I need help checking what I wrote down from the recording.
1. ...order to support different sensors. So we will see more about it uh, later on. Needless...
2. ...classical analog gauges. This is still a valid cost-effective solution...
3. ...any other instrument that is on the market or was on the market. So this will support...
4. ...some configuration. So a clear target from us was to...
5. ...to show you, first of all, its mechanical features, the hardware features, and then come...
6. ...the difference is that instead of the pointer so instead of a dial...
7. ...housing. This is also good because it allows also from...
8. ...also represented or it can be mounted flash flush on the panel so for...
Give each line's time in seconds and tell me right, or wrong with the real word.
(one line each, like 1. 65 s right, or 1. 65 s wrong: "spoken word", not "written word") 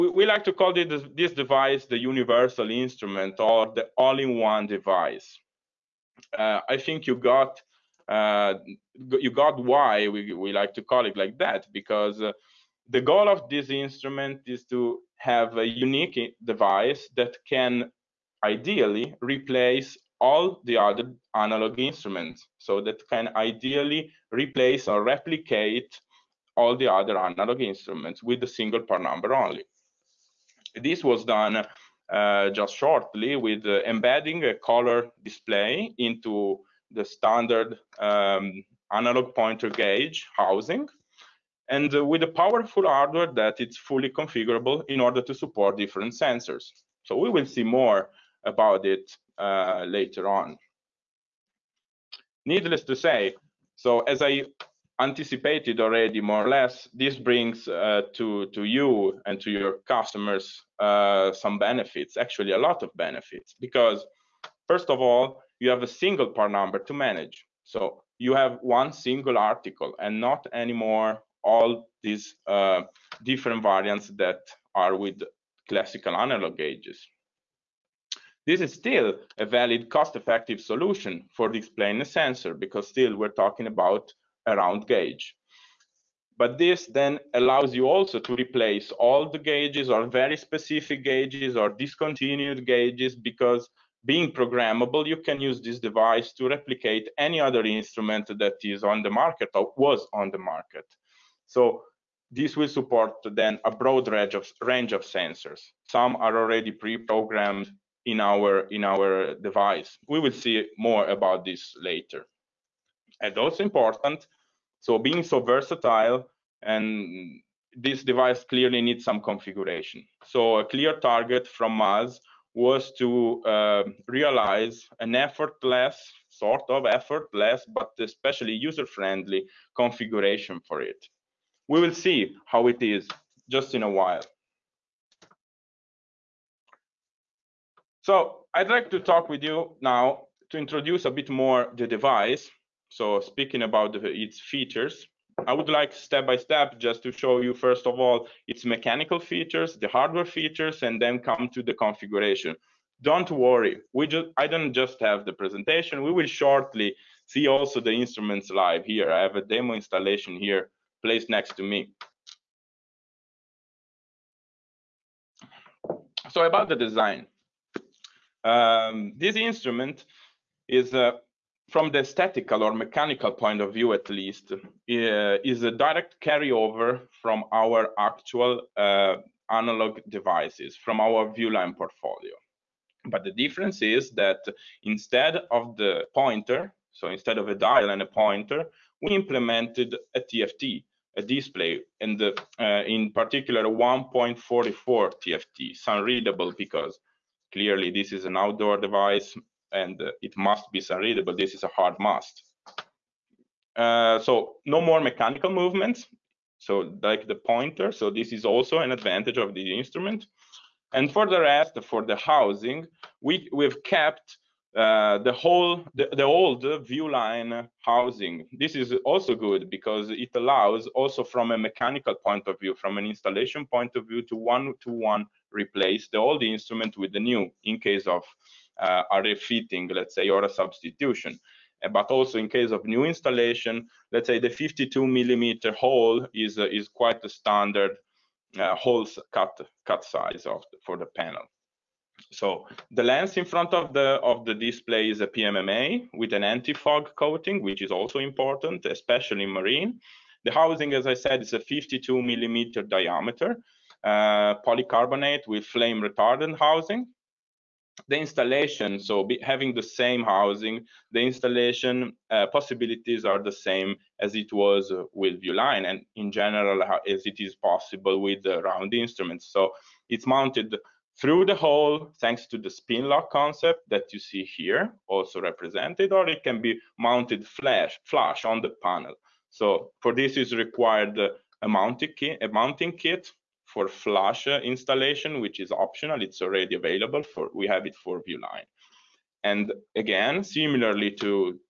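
1. 44 s right
2. 75 s right
3. 97 s right
4. 119 s right
5. 147 s right
6. 183 s right
7. 217 s right
8. 275 s right.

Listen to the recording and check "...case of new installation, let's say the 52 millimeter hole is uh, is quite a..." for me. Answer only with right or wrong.
right.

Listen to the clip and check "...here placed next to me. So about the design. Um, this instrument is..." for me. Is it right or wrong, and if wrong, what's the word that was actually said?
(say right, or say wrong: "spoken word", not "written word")
right.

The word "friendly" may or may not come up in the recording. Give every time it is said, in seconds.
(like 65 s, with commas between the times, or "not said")
128 s.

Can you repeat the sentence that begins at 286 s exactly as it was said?
It's already available for, we have it for Viewline.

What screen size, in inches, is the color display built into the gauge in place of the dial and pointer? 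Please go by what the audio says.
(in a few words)
1.44.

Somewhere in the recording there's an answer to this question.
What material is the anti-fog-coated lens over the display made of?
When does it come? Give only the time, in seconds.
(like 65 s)
245 s.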